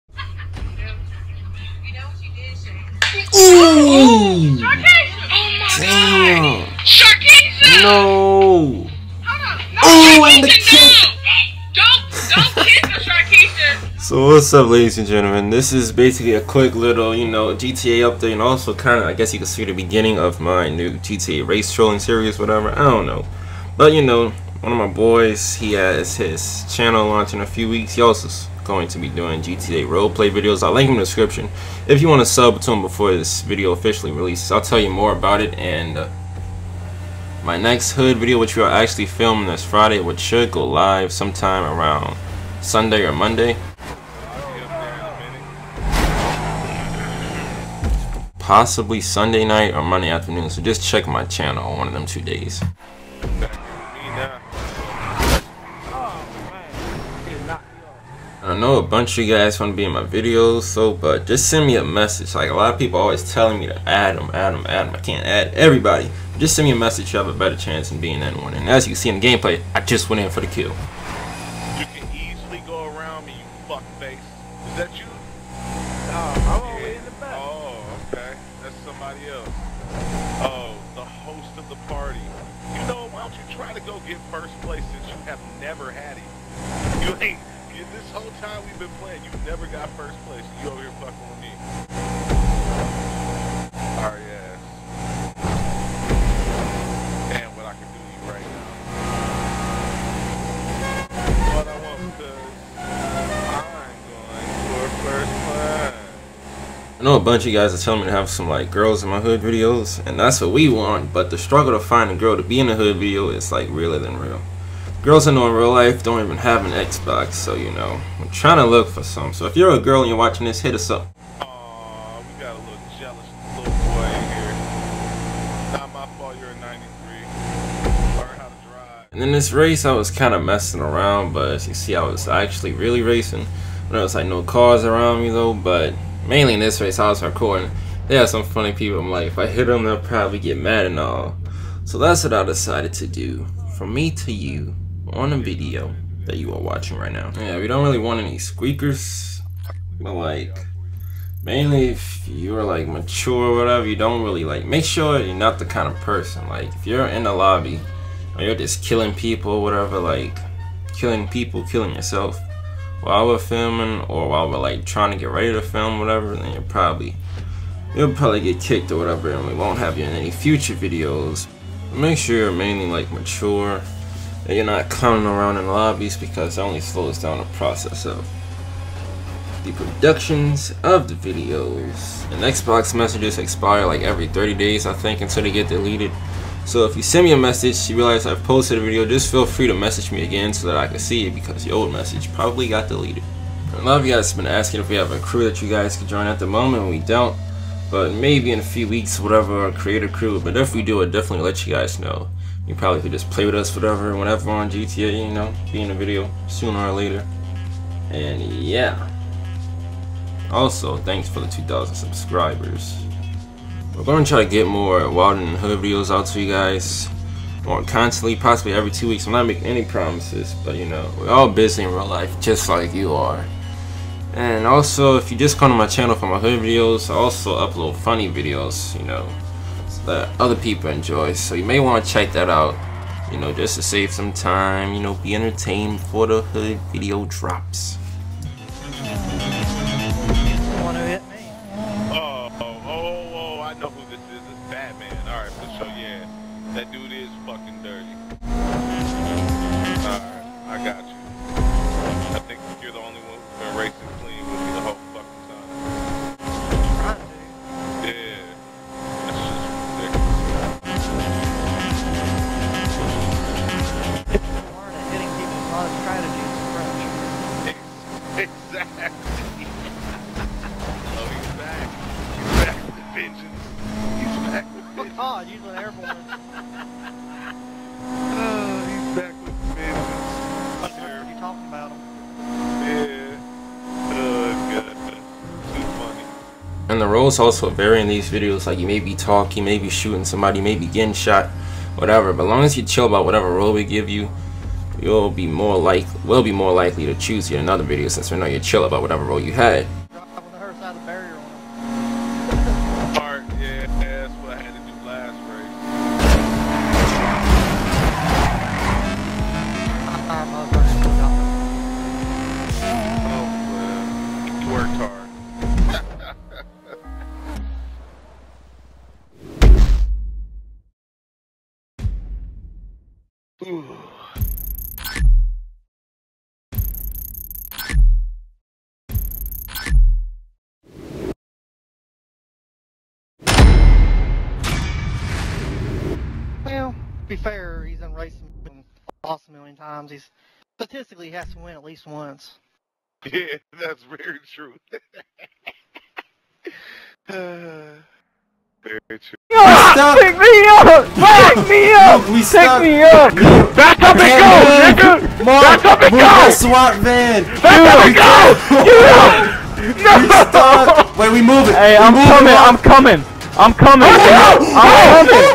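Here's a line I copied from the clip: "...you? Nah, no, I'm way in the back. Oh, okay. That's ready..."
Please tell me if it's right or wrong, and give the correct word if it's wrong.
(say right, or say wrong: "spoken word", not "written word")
wrong: "somebody", not "ready".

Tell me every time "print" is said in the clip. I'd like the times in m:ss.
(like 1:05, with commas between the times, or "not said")
not said.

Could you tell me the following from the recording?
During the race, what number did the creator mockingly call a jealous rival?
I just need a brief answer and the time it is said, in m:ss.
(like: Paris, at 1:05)
93, at 2:06.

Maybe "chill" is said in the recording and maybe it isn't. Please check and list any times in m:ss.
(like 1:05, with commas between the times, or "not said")
4:52, 4:58.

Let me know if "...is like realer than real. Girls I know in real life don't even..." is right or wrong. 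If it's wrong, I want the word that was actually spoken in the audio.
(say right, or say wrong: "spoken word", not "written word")
right.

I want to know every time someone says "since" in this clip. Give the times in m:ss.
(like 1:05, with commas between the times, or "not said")
1:24, 4:58.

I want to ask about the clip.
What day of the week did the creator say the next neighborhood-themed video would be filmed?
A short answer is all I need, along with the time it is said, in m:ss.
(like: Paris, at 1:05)
Friday, at 0:39.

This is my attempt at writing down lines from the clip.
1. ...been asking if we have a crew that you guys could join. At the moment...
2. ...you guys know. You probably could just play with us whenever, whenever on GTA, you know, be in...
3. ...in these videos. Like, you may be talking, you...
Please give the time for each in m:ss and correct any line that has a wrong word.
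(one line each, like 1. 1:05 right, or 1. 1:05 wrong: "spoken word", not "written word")
1. 3:14 right
2. 3:21 wrong: "forever", not "whenever"
3. 4:48 right.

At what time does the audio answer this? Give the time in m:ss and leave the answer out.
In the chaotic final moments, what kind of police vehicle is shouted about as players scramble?
5:56.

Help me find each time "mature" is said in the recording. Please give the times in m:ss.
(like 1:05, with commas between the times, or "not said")
2:32, 2:53.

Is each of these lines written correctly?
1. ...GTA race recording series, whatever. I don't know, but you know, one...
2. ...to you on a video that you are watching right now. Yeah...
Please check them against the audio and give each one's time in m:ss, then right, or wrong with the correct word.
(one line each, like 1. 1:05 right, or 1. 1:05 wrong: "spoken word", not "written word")
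1. 0:20 wrong: "trolling", not "recording"
2. 2:24 right.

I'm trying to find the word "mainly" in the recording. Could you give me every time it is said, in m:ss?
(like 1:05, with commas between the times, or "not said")
2:16, 2:31, 2:52.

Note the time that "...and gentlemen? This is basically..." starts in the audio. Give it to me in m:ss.
0:14.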